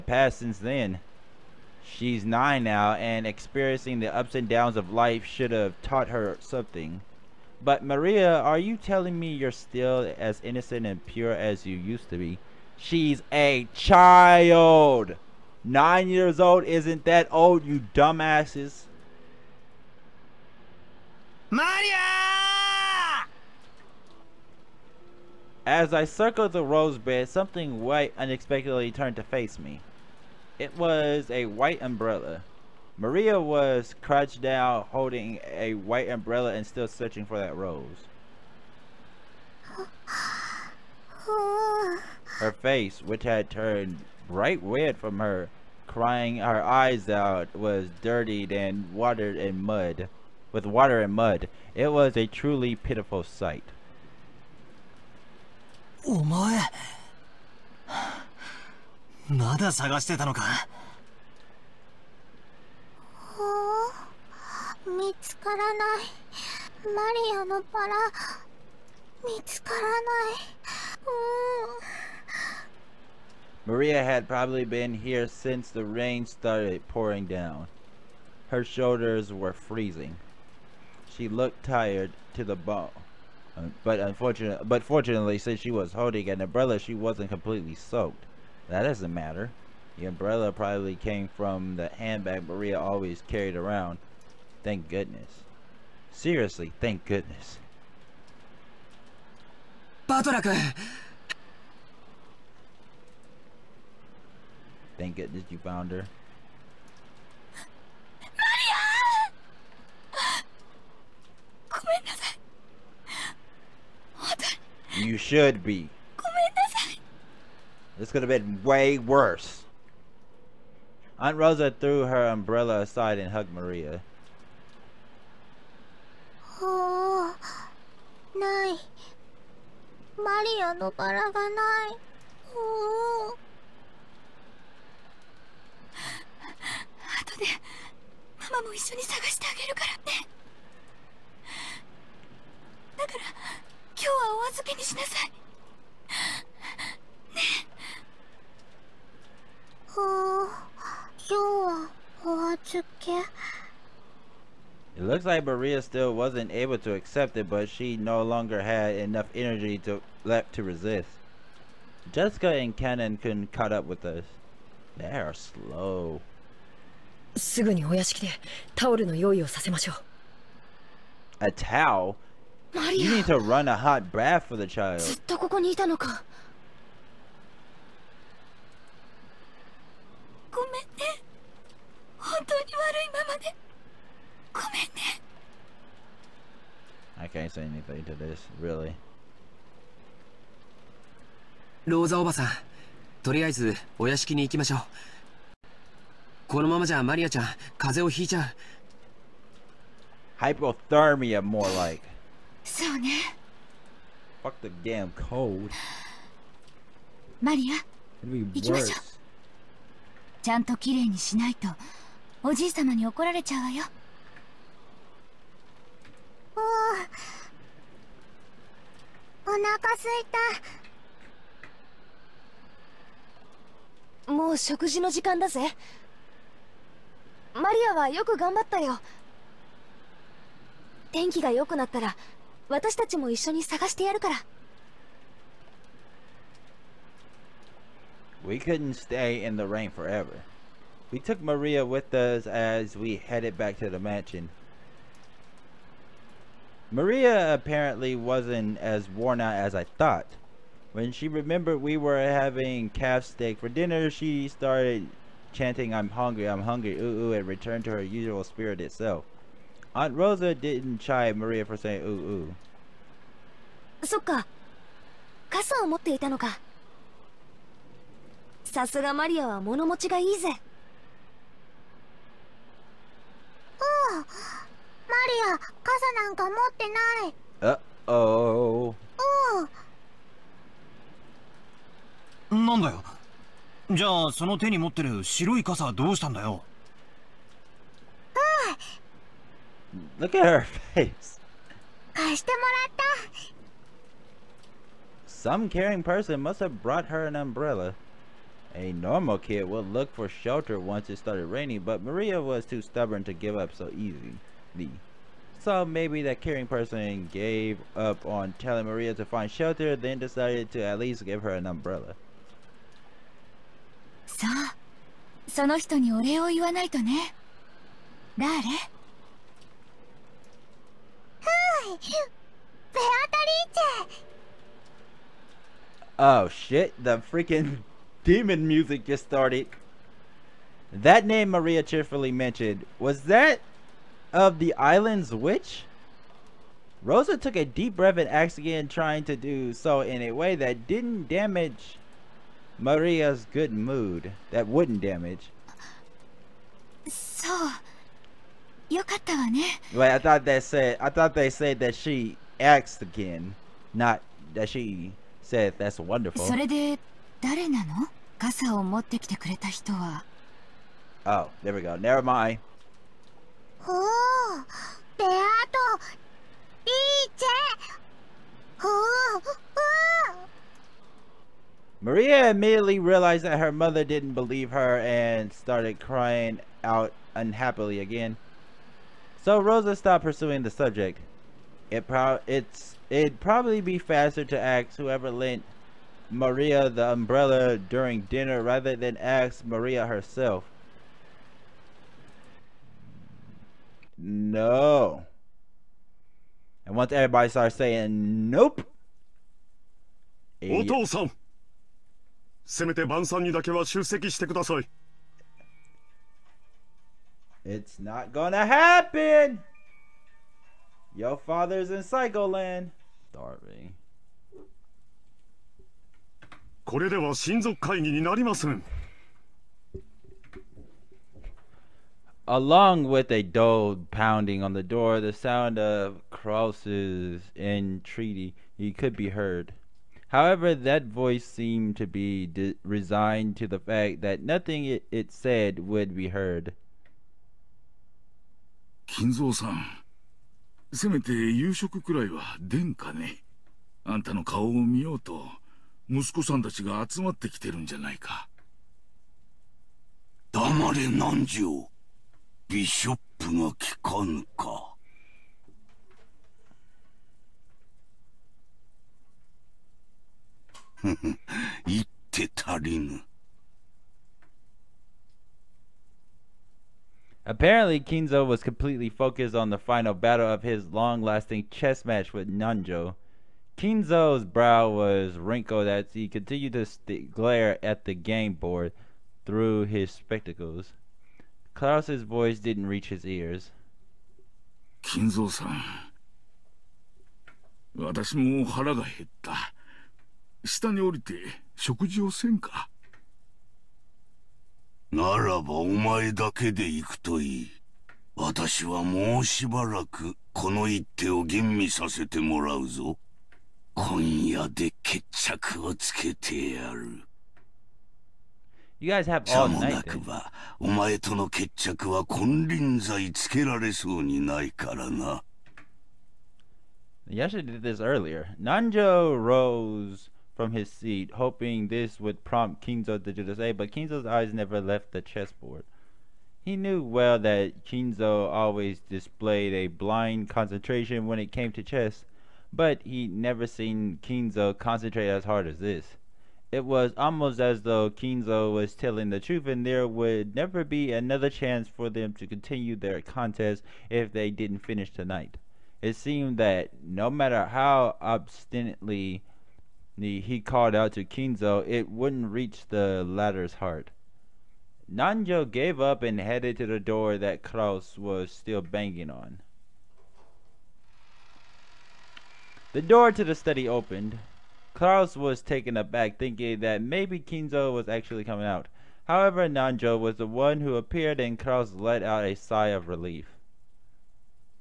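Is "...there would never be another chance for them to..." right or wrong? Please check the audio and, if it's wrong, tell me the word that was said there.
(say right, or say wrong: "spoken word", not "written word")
right.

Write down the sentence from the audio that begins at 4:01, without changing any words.
We took Maria with us as we headed back to the mansion.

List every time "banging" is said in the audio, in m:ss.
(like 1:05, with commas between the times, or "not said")
9:18.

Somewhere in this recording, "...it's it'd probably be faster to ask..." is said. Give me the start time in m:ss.
6:22.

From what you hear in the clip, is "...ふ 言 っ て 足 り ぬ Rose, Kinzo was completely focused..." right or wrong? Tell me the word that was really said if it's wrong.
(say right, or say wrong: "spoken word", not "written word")
wrong: "Apparently", not "Rose".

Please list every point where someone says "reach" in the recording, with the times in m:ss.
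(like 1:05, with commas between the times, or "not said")
8:02, 9:12.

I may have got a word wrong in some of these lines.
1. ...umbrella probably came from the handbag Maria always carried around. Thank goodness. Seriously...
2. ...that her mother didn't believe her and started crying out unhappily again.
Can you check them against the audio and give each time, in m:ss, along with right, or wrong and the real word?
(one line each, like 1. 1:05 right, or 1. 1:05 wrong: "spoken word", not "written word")
1. 1:30 right
2. 6:13 right.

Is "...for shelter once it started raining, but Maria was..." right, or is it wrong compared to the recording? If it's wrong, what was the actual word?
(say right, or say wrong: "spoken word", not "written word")
right.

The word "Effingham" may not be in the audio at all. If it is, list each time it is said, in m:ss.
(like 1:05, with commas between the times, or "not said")
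not said.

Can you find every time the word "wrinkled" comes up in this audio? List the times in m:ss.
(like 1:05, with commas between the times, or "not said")
7:55.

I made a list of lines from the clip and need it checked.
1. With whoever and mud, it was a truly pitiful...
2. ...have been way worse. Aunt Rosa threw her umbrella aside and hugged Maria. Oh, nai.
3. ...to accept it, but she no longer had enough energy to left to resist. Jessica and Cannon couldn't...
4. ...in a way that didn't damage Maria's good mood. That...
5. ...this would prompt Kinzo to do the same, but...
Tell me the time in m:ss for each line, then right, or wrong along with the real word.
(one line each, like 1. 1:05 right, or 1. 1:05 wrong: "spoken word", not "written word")
1. 0:50 wrong: "water", not "whoever"
2. 1:58 right
3. 2:36 right
4. 5:40 right
5. 8:41 right.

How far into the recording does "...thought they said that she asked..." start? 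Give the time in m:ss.
5:51.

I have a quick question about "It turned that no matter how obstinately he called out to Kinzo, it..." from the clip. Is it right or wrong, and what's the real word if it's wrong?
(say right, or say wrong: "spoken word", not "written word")
wrong: "seemed", not "turned".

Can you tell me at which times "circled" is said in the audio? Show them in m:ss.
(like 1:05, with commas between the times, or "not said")
0:26.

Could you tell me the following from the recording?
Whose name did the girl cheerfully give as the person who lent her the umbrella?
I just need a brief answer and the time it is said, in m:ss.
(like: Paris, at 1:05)
Beatrice, at 5:22.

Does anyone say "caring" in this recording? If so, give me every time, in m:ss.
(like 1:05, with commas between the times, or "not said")
4:55, 5:06.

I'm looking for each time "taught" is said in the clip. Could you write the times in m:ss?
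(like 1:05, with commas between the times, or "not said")
0:05.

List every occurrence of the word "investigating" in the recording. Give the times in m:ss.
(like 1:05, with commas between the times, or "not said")
not said.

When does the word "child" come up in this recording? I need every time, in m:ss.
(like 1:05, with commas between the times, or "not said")
0:13, 2:54.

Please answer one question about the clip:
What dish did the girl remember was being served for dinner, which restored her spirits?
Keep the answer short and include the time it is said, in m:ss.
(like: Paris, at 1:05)
Calf steak, at 4:12.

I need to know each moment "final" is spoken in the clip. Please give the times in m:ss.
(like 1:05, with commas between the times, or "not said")
7:49.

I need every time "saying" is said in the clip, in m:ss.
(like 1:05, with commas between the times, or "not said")
4:21, 6:37.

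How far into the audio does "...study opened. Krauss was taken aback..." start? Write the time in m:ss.
9:23.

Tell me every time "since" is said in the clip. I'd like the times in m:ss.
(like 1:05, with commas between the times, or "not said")
0:00, 1:15, 1:25.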